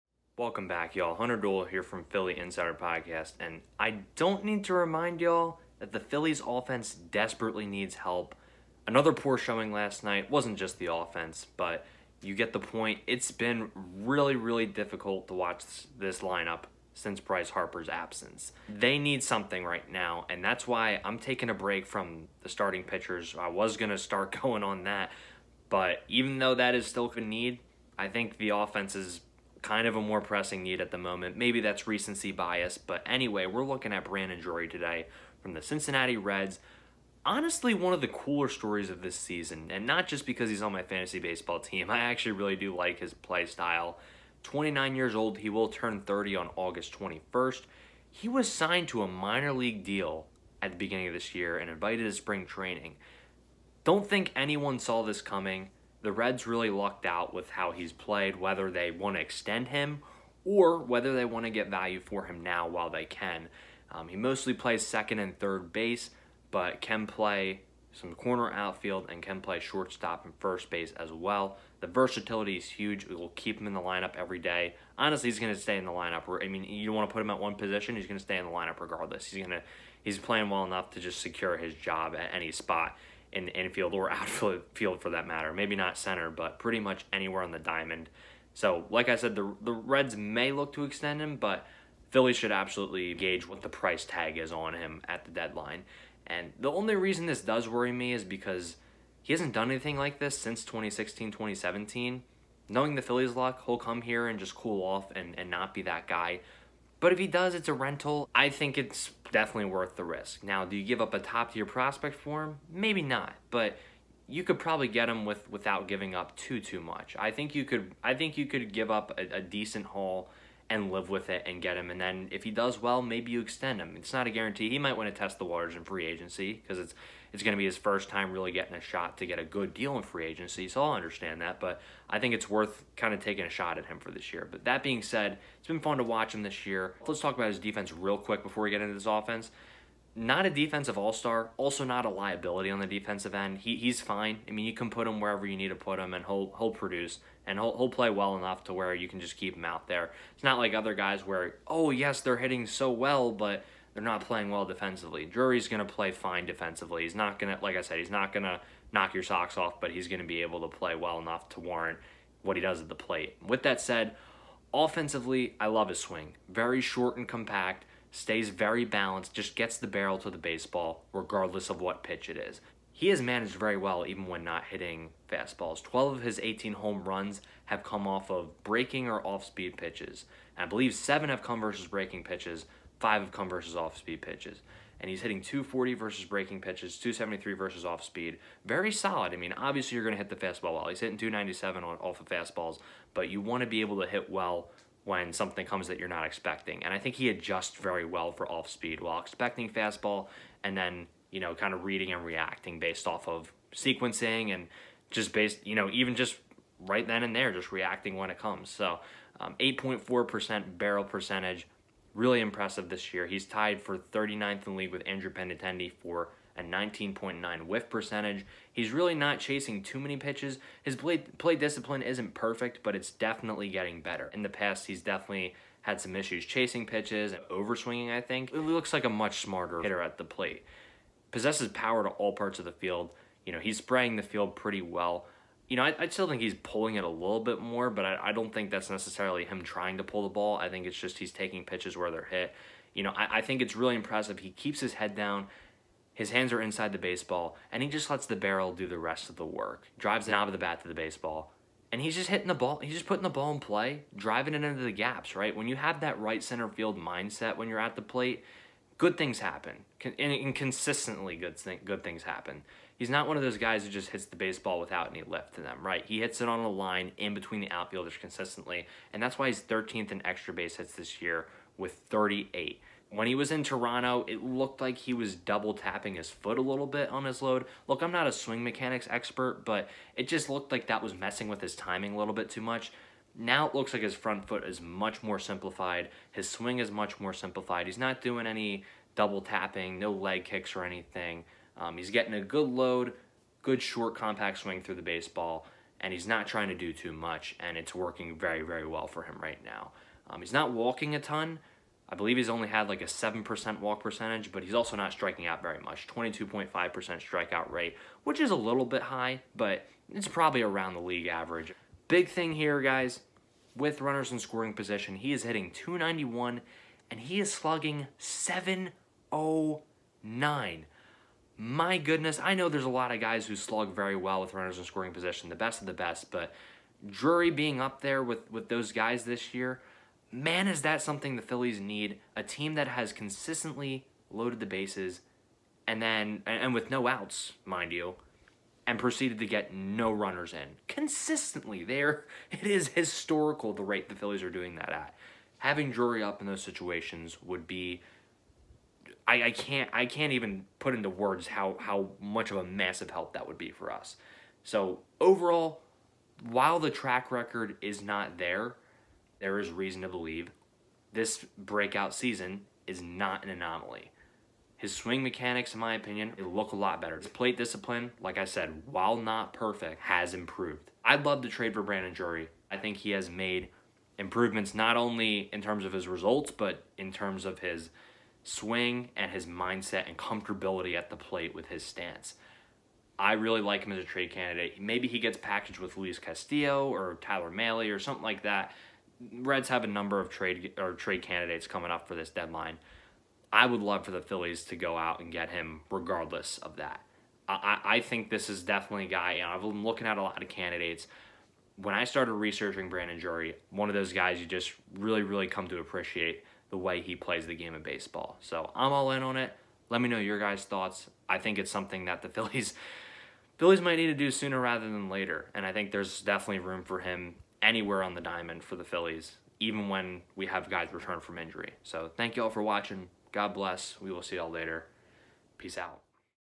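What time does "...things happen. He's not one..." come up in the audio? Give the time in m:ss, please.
4:22.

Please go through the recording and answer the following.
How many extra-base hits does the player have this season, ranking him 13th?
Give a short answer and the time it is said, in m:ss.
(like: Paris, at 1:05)
38, at 4:31.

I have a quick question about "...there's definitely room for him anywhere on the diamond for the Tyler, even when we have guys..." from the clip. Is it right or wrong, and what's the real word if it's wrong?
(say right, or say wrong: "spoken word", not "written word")
wrong: "Phillies", not "Tyler".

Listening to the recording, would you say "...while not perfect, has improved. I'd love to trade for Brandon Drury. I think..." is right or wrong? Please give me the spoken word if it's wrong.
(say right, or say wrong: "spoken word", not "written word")
right.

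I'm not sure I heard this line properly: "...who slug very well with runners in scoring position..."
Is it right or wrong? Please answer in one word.
right.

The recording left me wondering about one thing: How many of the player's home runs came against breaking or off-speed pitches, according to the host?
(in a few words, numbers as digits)
12.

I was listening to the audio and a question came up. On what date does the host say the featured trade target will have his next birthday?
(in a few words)
August 21st.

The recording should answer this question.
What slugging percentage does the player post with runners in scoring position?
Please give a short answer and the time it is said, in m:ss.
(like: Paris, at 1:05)
709, at 5:18.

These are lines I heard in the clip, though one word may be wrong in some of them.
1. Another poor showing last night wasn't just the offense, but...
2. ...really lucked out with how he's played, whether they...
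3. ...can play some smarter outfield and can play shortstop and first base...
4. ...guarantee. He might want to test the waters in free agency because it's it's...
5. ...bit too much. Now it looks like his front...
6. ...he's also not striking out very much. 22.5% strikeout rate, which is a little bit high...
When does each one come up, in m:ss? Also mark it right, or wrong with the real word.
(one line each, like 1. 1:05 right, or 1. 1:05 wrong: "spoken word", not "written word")
1. 0:08 right
2. 0:56 right
3. 1:06 wrong: "corner", not "smarter"
4. 2:04 right
5. 4:42 right
6. 5:04 right.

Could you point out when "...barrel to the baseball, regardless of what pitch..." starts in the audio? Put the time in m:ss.
2:49.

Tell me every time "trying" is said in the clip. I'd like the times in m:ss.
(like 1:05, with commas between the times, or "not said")
3:59, 4:56.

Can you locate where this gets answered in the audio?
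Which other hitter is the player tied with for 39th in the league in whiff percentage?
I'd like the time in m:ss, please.
3:35.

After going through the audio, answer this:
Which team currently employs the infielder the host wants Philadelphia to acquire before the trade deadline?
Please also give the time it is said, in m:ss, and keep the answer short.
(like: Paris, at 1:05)
Cincinnati Reds, at 0:35.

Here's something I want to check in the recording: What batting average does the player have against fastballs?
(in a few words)
297.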